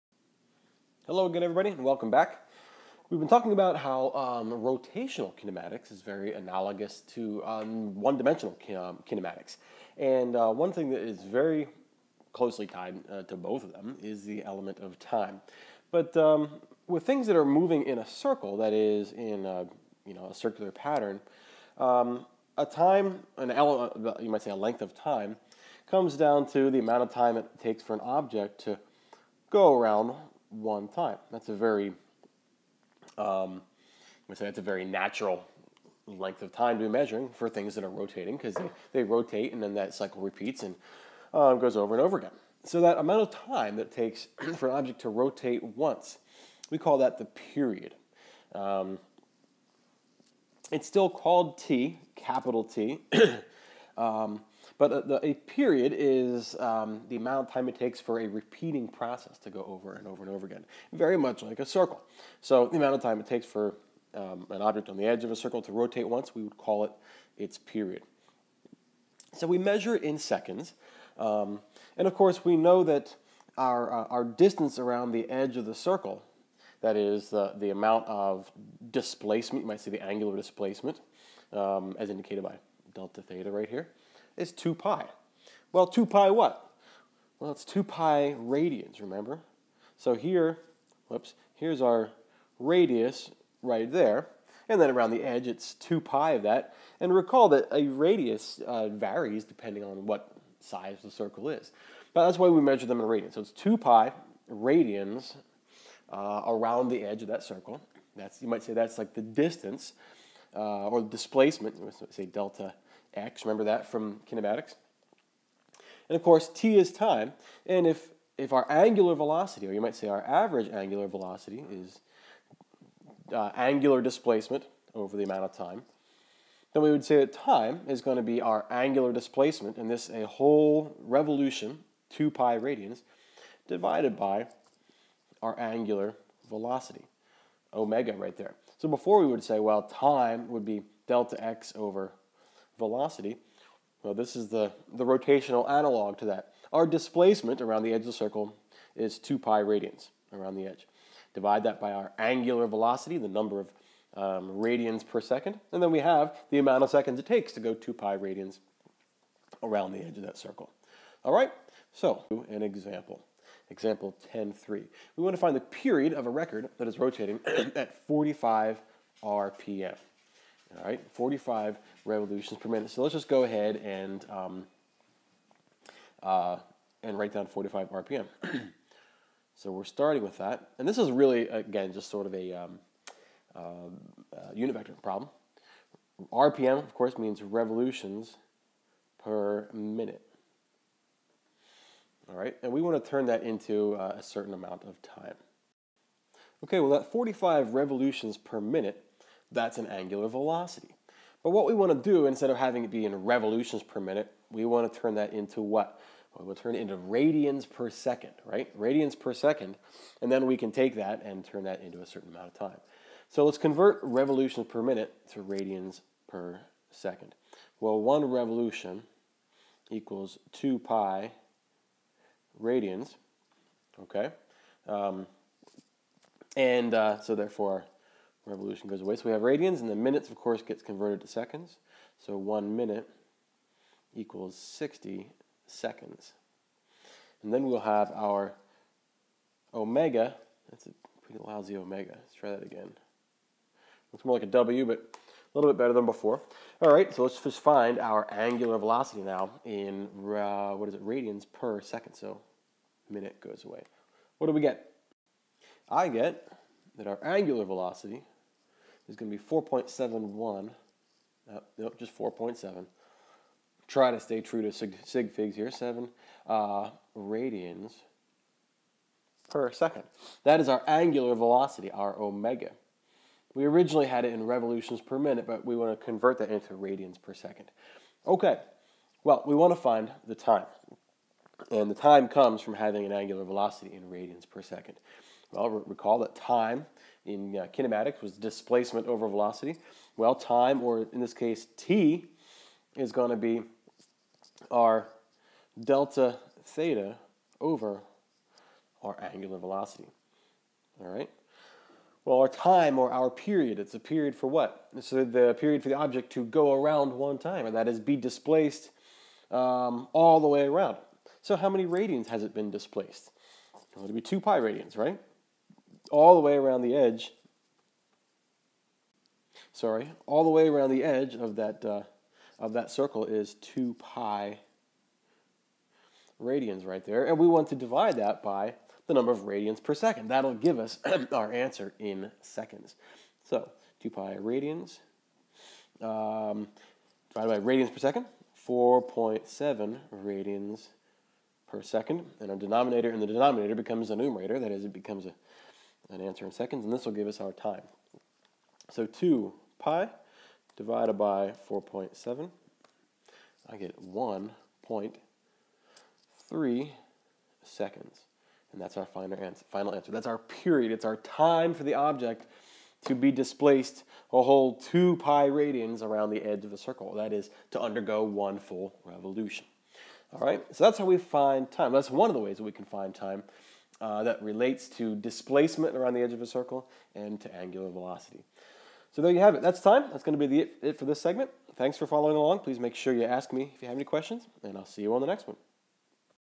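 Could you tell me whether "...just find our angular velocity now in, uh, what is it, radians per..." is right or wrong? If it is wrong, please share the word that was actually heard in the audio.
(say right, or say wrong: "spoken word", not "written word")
right.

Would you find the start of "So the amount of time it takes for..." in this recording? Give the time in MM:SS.
01:02.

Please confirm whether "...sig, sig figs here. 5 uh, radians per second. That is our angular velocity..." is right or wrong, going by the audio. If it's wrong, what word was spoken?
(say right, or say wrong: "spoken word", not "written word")
wrong: "7", not "5".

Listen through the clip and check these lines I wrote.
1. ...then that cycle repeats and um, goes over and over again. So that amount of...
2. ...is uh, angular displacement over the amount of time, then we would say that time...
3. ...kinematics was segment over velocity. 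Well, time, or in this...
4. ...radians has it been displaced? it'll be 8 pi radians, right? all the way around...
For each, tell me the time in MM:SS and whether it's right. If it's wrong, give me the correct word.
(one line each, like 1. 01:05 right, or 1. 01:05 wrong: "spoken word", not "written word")
1. 00:39 right
2. 02:01 right
3. 04:47 wrong: "displacement", not "segment"
4. 05:11 wrong: "2", not "8".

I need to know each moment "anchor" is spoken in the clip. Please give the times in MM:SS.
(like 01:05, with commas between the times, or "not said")
not said.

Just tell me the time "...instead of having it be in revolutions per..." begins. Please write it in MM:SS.
03:22.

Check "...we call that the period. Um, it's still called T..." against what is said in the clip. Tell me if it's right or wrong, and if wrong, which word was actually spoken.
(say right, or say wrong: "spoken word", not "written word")
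right.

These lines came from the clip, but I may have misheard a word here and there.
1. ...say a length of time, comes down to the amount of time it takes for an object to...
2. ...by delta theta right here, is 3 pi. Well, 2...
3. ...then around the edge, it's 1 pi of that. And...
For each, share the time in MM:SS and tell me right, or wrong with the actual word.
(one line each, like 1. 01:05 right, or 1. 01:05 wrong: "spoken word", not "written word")
1. 00:24 right
2. 01:22 wrong: "2", not "3"
3. 01:34 wrong: "2", not "1".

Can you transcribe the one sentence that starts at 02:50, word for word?
All right, 45 revolutions per minute.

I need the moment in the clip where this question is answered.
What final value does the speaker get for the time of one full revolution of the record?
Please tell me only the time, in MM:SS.
05:54.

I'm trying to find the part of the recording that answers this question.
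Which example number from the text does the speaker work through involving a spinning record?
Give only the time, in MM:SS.
02:43.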